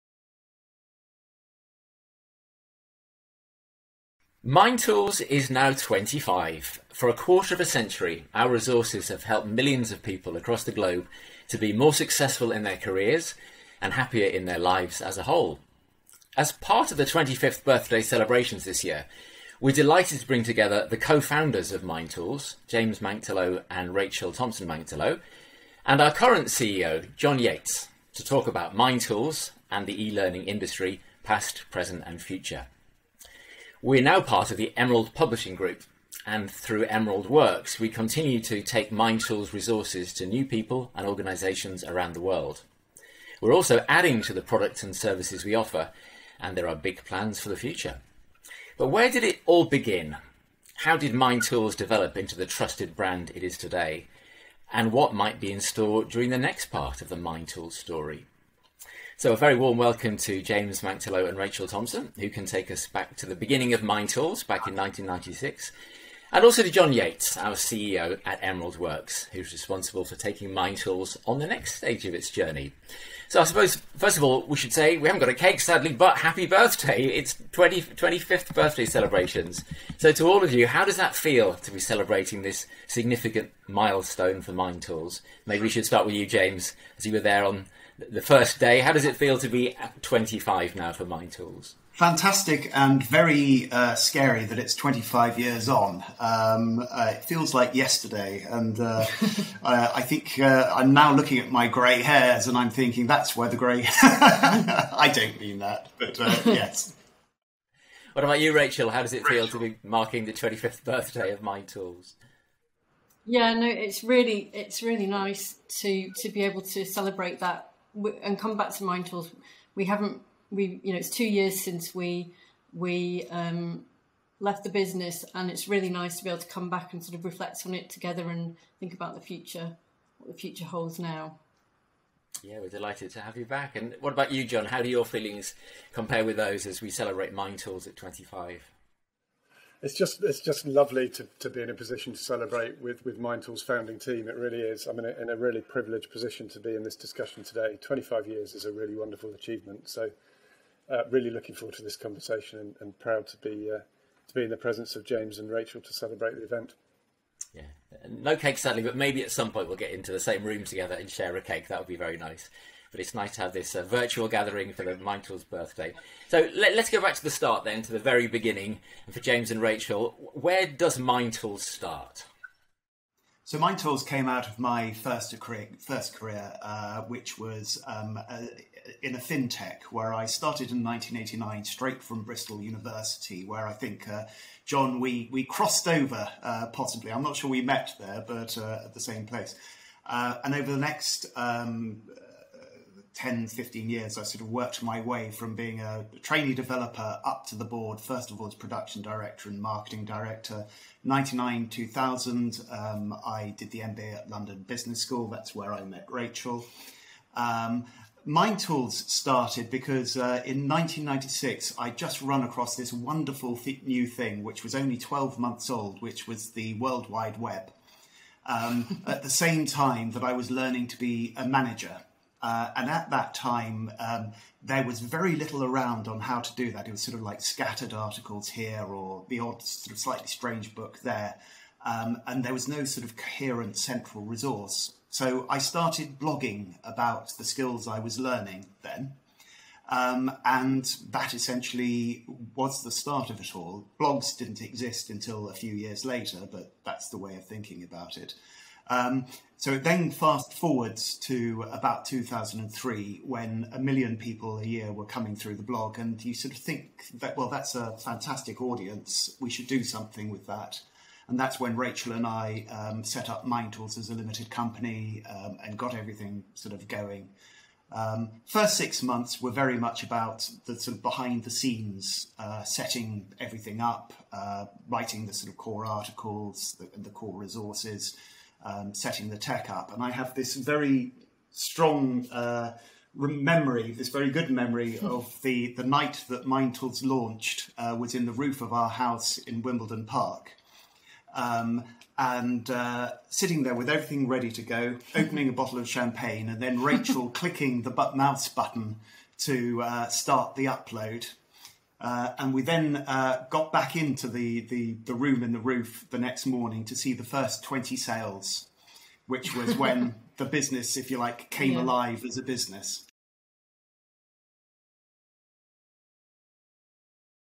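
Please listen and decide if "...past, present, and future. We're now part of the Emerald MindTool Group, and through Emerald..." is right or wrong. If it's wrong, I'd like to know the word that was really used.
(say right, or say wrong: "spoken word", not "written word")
wrong: "Publishing", not "MindTool".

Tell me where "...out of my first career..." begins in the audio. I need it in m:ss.
2:54.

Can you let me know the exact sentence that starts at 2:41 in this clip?
That would be very nice but it's nice to have this uh, virtual gathering for the Michael's birthday.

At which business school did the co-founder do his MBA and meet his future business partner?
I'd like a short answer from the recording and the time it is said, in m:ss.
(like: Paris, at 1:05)
London Business School, at 3:24.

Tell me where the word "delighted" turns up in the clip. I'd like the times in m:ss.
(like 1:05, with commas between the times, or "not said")
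0:19, 2:12.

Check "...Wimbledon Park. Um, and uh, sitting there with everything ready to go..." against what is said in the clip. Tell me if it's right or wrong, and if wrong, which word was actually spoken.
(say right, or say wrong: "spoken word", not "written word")
right.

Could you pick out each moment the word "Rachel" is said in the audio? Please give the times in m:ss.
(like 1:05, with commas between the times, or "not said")
0:23, 1:01, 1:48, 2:35, 2:49, 3:26, 4:21, 4:56.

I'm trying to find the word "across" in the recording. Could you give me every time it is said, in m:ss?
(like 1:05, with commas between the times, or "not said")
0:10, 3:32.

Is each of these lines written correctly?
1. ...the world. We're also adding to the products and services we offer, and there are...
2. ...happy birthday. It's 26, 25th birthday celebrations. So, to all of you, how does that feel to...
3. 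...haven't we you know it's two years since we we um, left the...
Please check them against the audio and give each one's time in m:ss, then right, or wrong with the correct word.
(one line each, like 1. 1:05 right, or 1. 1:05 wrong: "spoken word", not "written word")
1. 0:42 right
2. 1:16 wrong: "20", not "26"
3. 1:59 right.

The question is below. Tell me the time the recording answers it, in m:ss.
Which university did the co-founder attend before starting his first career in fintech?
3:02.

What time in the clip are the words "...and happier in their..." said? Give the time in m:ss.
0:13.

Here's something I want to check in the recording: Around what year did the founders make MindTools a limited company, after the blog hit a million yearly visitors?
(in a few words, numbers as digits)
2003.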